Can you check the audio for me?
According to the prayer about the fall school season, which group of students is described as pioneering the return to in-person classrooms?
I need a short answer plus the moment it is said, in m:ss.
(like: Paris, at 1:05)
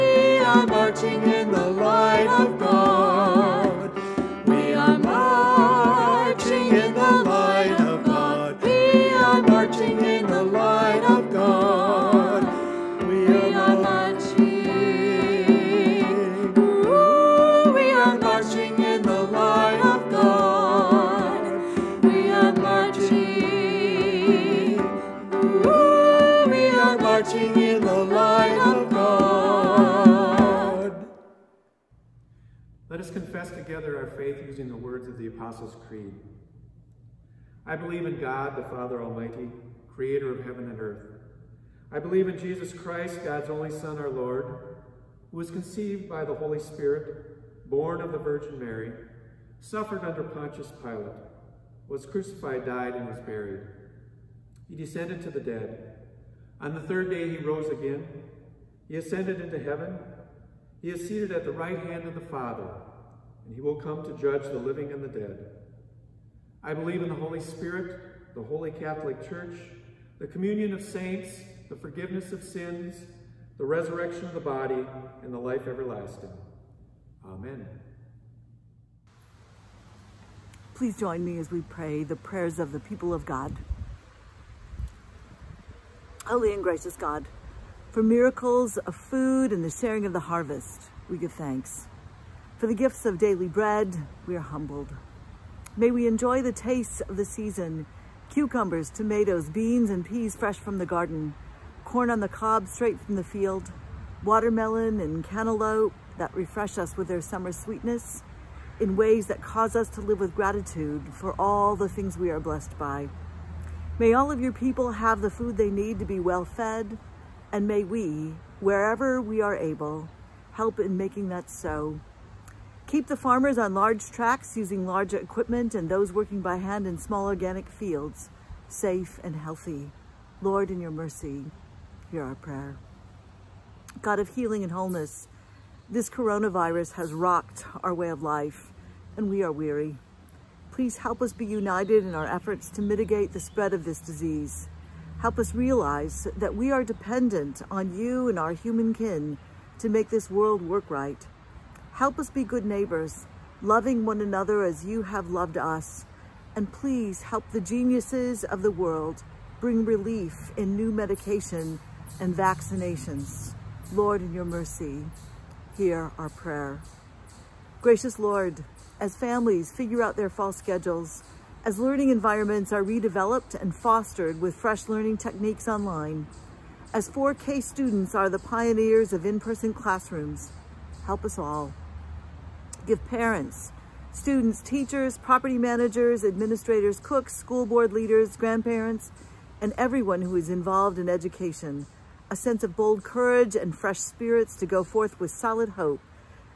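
4K students, at 2:57.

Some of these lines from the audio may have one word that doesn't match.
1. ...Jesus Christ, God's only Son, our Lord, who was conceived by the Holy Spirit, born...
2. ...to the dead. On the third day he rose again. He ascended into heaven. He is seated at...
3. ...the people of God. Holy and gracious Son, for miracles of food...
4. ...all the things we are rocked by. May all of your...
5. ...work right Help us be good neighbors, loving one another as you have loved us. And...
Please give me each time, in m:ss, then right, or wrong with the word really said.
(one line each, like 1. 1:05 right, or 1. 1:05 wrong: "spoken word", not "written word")
1. 0:42 right
2. 0:55 right
3. 1:22 wrong: "God", not "Son"
4. 1:51 wrong: "blessed", not "rocked"
5. 2:30 right.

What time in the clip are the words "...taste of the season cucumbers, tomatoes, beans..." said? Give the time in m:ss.
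1:36.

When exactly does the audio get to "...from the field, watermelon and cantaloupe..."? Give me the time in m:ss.
1:42.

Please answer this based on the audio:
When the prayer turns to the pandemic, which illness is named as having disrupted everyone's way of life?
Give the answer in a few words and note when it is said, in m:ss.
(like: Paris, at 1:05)
coronavirus, at 2:16.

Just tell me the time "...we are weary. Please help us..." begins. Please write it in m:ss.
2:19.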